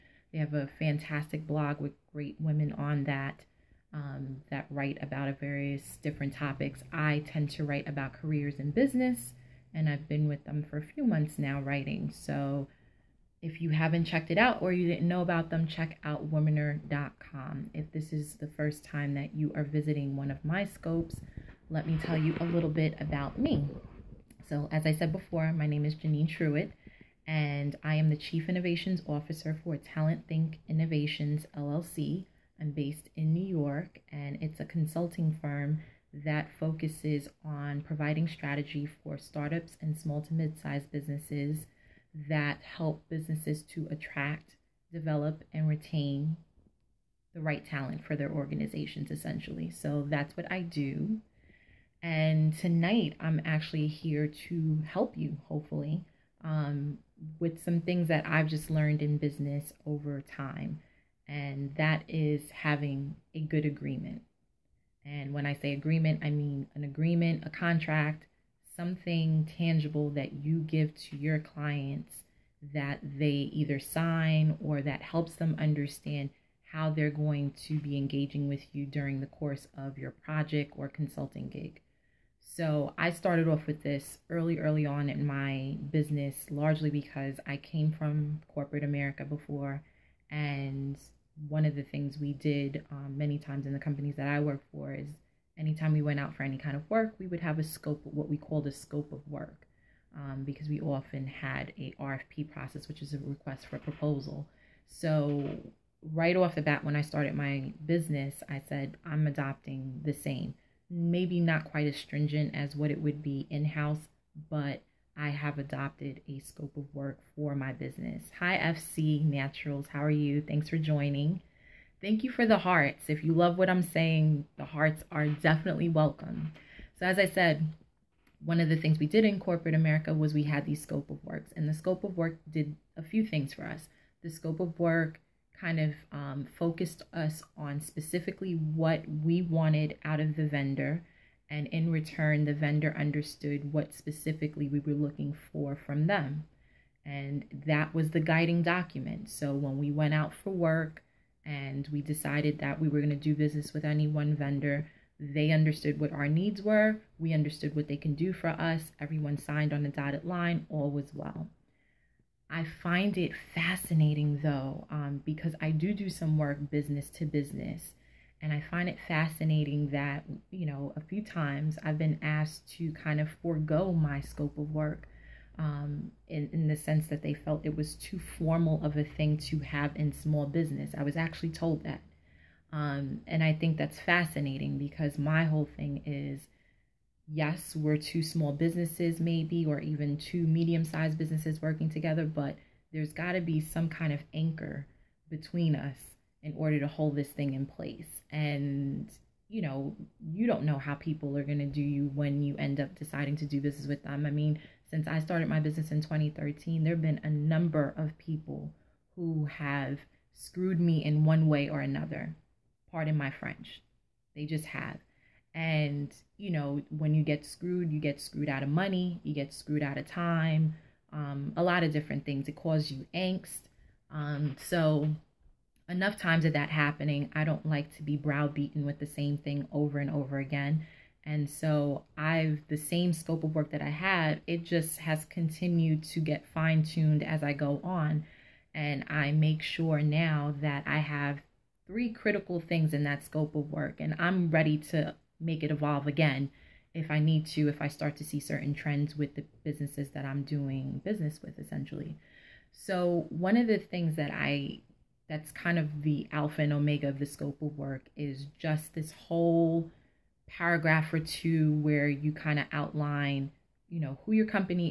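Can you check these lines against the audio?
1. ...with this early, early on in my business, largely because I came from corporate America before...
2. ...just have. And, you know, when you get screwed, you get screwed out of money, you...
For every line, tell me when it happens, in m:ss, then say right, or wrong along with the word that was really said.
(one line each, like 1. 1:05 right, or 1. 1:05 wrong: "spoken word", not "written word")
1. 1:23 right
2. 3:34 right.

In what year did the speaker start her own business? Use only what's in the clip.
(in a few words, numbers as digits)
2013.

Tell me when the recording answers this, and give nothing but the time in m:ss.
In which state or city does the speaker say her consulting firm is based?
0:33.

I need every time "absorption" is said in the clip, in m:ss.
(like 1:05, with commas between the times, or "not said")
not said.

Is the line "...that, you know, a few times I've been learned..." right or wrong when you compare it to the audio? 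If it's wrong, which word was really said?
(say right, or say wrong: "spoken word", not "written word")
wrong: "asked", not "learned".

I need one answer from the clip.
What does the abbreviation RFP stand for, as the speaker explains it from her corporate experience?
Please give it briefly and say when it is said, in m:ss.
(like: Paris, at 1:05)
request for a proposal, at 1:43.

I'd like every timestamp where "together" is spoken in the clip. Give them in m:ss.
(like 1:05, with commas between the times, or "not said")
3:11.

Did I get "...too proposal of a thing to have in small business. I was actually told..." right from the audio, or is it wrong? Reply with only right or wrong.
wrong.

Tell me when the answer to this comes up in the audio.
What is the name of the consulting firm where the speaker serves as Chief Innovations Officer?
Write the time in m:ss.
0:29.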